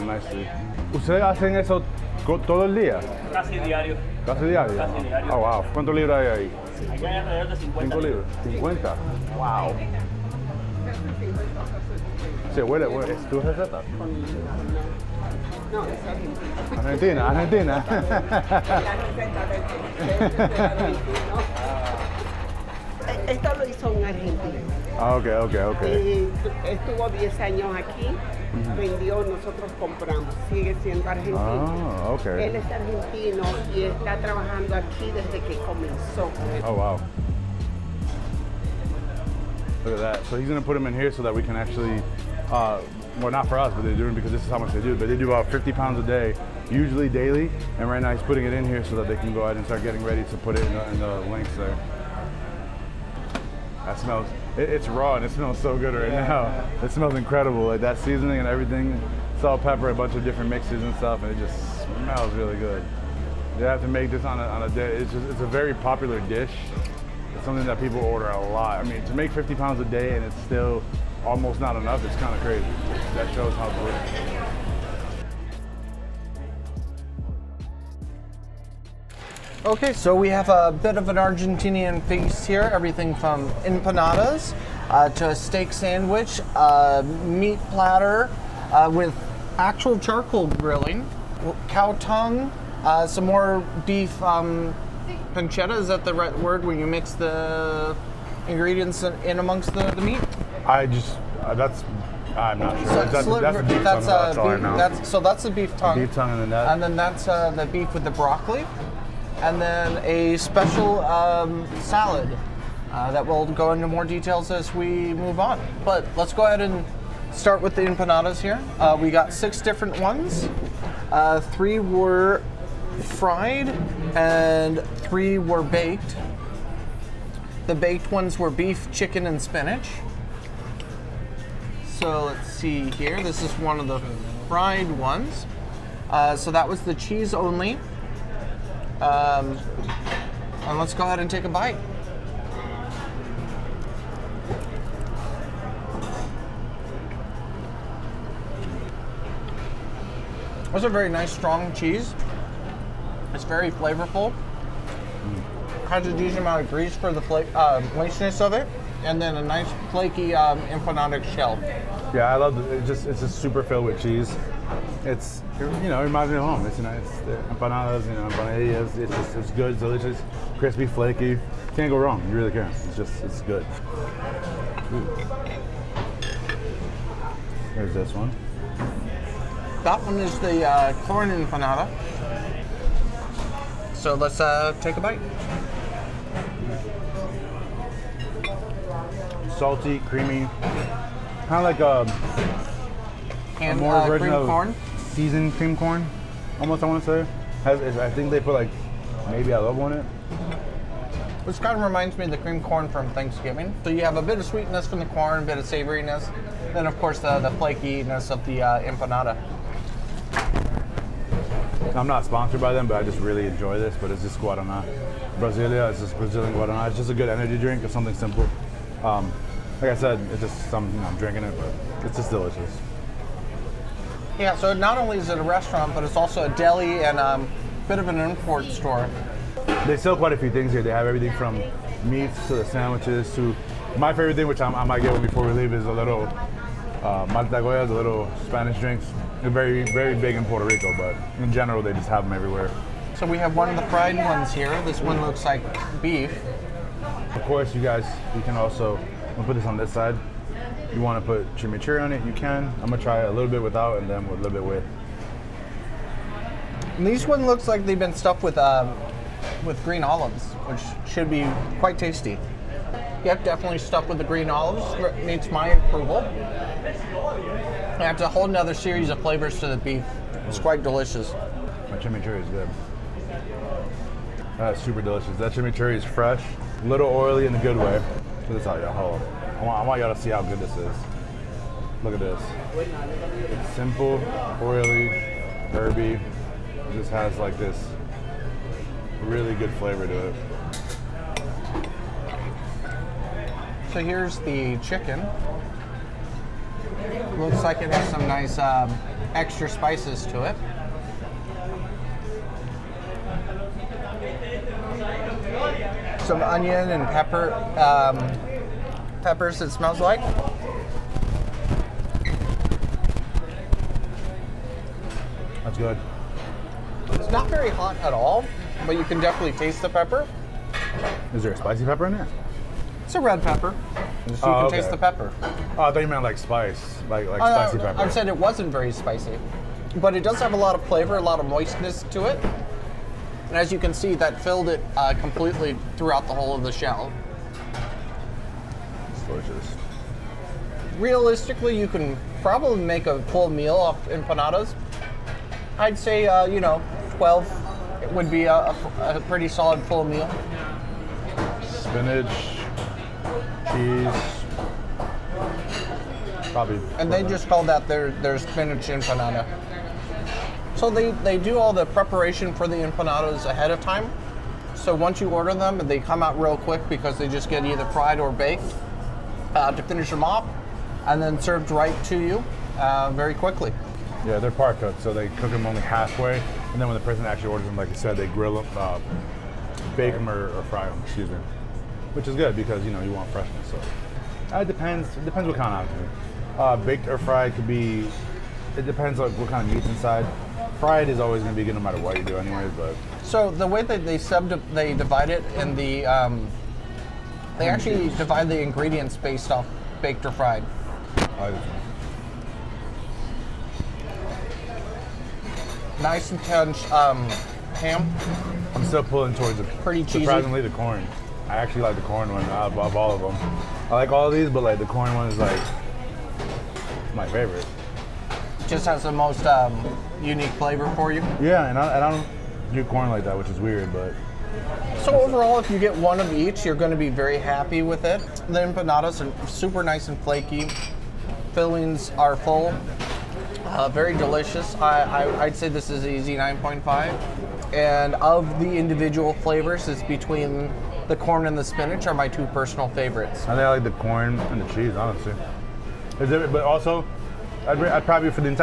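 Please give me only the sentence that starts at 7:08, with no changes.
The empanadas are super nice and flaky fillings are full.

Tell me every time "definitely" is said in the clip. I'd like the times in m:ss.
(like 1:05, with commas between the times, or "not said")
4:23, 5:19.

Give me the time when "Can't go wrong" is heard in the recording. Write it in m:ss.
2:51.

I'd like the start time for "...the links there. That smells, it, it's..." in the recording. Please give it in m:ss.
0:50.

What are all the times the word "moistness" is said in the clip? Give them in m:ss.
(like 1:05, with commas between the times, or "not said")
2:37, 5:31.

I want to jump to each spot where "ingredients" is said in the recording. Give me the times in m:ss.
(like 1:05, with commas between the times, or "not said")
1:38, 6:38.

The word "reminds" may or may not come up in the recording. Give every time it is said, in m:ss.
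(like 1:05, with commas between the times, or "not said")
2:46, 3:21.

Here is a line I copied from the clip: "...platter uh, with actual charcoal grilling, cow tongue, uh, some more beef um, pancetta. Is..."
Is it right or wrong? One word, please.
right.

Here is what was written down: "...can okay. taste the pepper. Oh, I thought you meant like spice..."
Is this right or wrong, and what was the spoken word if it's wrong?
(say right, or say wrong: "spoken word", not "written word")
right.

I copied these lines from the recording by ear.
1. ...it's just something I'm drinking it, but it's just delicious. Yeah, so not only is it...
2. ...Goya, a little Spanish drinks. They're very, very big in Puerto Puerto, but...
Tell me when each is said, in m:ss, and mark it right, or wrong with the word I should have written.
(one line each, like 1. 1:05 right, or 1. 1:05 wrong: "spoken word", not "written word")
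1. 3:40 right
2. 3:57 wrong: "Rico", not "Puerto".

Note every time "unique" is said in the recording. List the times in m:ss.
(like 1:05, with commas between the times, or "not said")
7:00.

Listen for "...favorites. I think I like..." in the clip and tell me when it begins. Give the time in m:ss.
7:22.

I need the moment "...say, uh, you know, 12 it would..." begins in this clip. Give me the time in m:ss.
5:45.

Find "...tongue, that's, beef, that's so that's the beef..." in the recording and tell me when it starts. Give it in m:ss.
1:44.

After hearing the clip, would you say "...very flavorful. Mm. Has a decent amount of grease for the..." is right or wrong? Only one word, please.
right.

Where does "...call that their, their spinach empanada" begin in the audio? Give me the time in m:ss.
5:57.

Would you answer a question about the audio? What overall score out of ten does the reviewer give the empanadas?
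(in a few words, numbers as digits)
9.5.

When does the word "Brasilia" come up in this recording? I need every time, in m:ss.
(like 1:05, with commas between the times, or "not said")
3:35.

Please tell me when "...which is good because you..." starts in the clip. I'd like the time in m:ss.
6:22.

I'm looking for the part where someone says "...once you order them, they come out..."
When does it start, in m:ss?
6:04.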